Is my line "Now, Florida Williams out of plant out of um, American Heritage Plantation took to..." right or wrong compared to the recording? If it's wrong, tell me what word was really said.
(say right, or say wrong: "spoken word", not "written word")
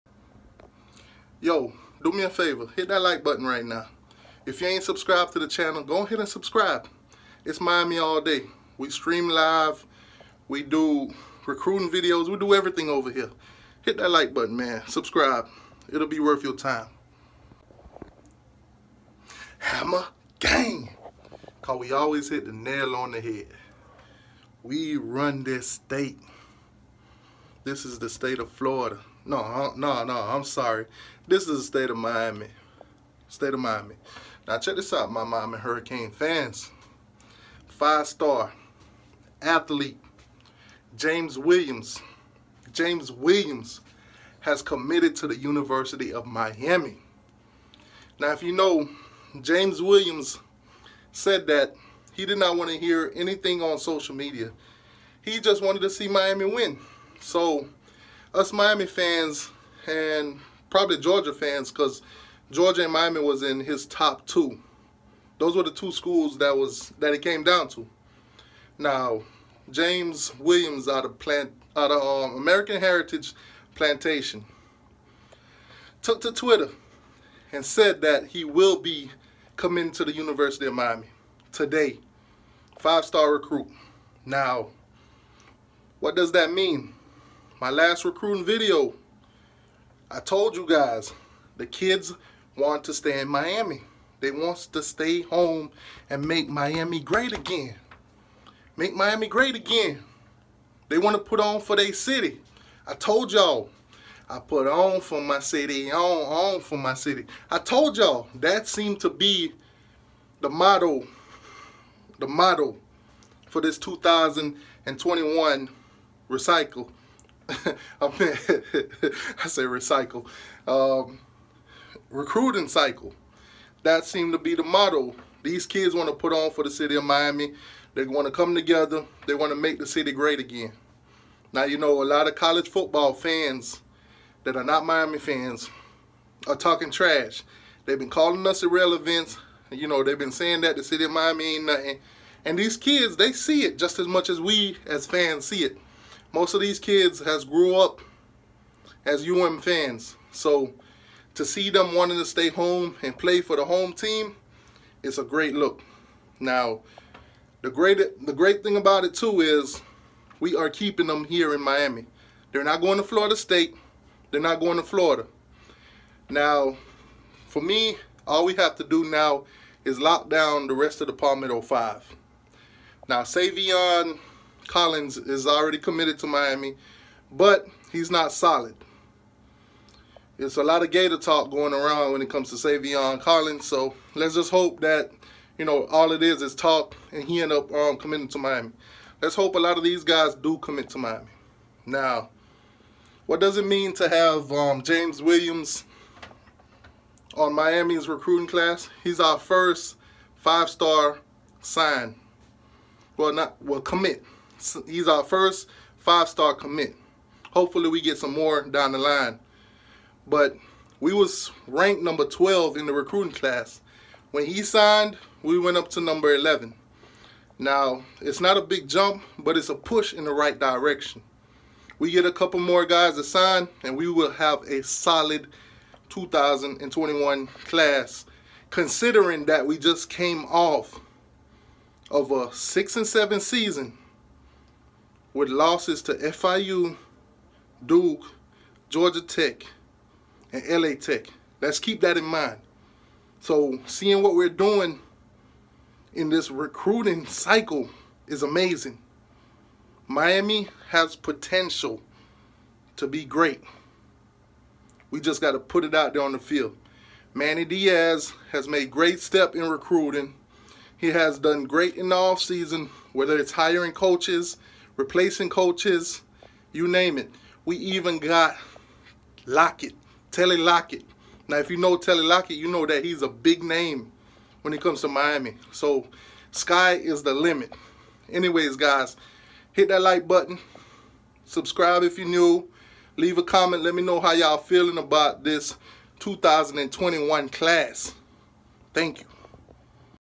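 wrong: "James", not "Florida".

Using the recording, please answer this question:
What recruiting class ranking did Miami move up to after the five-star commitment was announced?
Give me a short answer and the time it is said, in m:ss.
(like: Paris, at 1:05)
11, at 3:36.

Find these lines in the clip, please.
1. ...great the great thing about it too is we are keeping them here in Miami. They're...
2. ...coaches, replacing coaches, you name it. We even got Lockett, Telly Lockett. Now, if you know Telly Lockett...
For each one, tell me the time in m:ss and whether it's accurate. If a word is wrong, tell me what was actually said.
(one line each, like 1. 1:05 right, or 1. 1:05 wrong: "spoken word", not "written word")
1. 2:37 right
2. 4:23 right.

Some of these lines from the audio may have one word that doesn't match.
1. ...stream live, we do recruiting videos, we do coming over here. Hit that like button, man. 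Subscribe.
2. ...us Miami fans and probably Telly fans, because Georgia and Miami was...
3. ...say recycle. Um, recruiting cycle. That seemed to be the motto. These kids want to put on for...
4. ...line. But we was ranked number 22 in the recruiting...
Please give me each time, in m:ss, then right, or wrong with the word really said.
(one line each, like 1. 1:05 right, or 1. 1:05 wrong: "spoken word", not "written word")
1. 0:08 wrong: "everything", not "coming"
2. 0:58 wrong: "Georgia", not "Telly"
3. 1:59 right
4. 3:28 wrong: "12", not "22".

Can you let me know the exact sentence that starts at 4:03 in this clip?
So seeing what we're doing in this recruiting cycle is amazing.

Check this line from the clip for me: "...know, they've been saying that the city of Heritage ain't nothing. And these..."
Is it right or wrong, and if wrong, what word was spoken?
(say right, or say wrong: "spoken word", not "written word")
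wrong: "Miami", not "Heritage".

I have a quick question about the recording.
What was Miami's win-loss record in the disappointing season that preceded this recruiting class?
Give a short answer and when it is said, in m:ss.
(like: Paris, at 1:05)
6 and 7, at 3:52.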